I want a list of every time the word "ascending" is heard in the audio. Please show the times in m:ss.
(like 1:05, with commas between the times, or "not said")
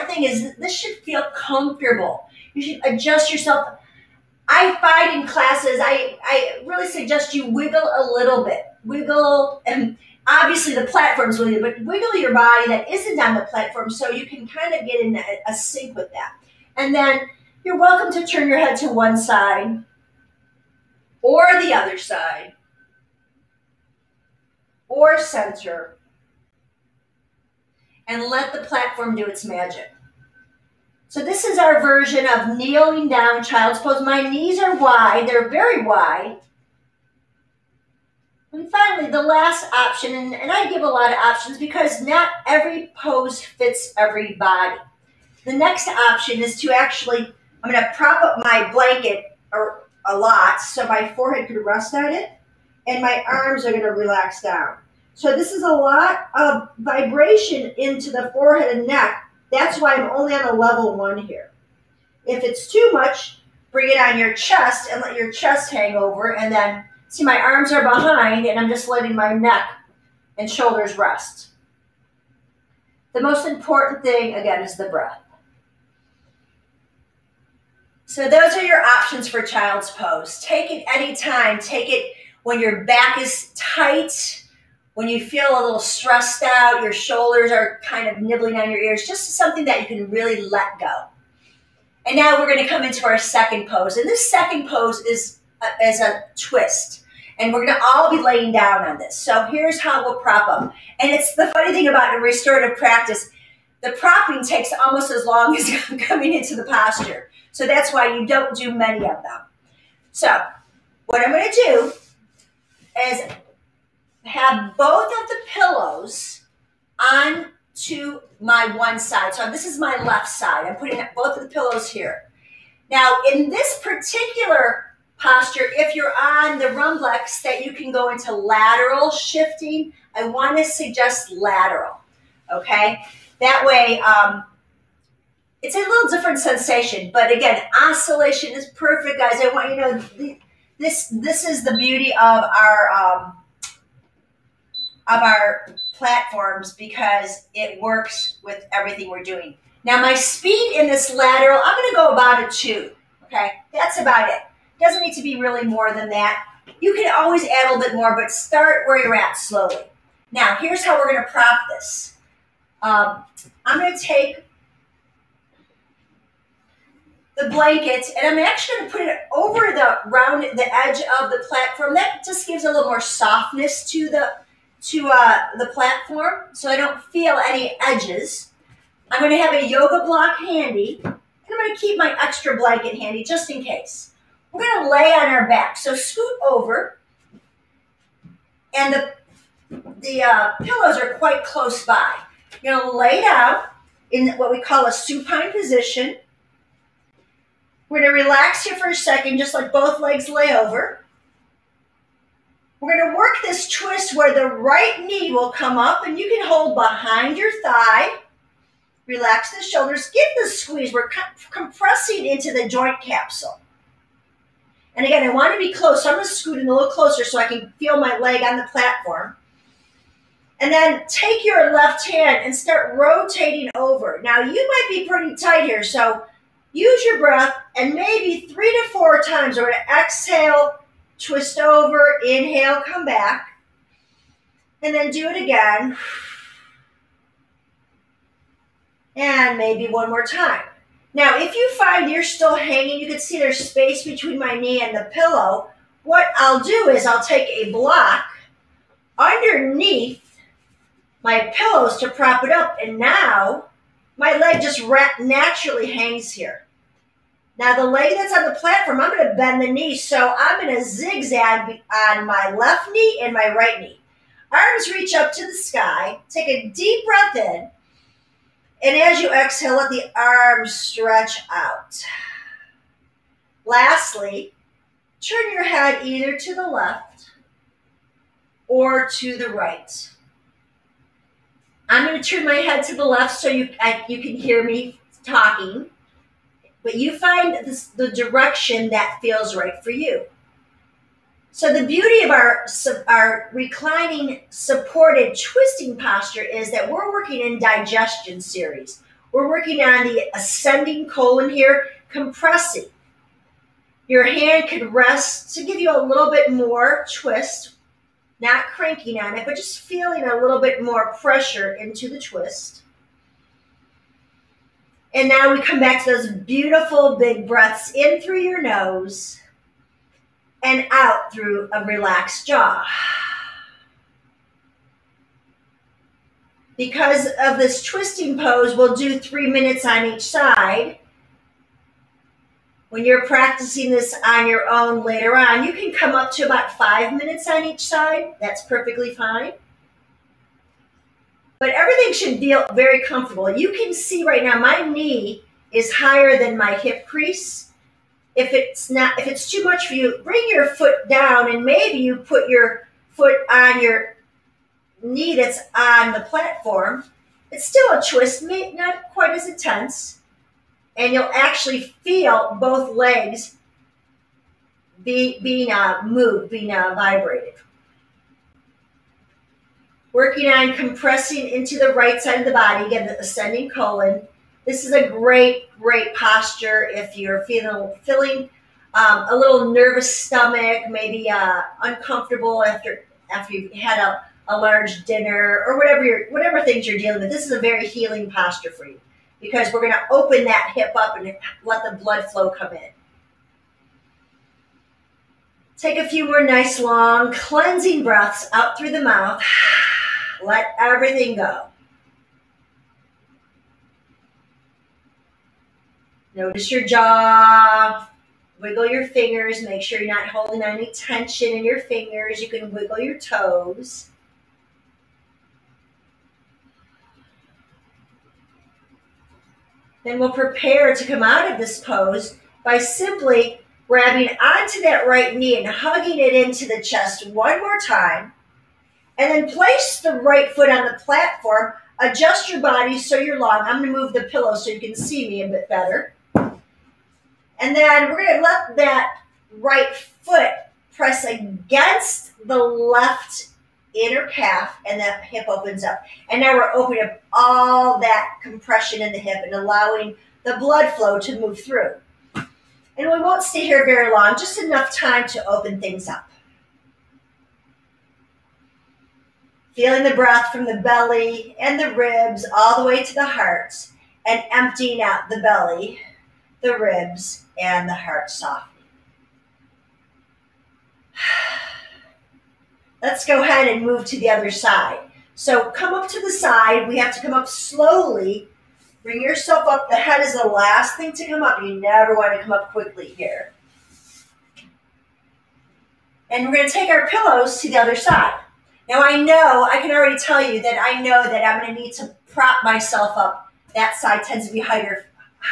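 5:00, 6:13.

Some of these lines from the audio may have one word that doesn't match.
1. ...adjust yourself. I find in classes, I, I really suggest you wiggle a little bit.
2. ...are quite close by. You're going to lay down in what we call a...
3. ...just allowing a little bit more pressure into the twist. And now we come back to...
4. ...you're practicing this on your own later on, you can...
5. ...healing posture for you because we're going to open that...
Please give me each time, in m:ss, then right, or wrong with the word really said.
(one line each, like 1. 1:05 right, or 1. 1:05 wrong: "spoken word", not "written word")
1. 0:02 right
2. 3:10 right
3. 5:09 wrong: "feeling", not "allowing"
4. 5:33 right
5. 6:27 right.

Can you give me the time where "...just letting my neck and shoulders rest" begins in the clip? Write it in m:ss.
1:08.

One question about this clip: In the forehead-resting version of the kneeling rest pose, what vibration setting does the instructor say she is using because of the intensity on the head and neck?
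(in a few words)
level 1.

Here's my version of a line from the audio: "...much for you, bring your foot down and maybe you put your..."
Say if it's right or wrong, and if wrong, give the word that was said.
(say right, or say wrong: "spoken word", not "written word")
right.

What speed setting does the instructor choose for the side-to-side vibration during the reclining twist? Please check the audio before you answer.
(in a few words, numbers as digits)
2.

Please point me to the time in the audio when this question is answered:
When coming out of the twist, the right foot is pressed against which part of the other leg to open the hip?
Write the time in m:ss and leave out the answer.
7:22.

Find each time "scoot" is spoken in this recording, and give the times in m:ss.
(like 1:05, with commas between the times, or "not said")
3:05, 3:36.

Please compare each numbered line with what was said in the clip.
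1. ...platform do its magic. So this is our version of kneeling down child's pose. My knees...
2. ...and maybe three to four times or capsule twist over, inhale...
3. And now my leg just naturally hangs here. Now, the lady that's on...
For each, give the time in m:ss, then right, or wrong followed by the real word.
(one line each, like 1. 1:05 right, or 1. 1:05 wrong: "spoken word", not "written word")
1. 0:28 right
2. 3:47 wrong: "exhale", not "capsule"
3. 4:12 right.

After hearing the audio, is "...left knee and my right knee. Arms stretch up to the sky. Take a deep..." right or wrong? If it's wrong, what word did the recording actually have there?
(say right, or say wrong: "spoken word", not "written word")
wrong: "reach", not "stretch".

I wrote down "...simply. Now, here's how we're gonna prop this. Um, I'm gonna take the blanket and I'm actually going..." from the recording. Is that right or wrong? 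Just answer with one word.
wrong.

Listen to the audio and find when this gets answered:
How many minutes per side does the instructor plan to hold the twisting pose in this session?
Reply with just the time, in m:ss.
5:29.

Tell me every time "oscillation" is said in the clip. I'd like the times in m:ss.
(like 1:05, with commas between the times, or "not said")
2:17.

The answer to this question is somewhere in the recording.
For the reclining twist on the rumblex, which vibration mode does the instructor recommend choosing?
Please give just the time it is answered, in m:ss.
2:08.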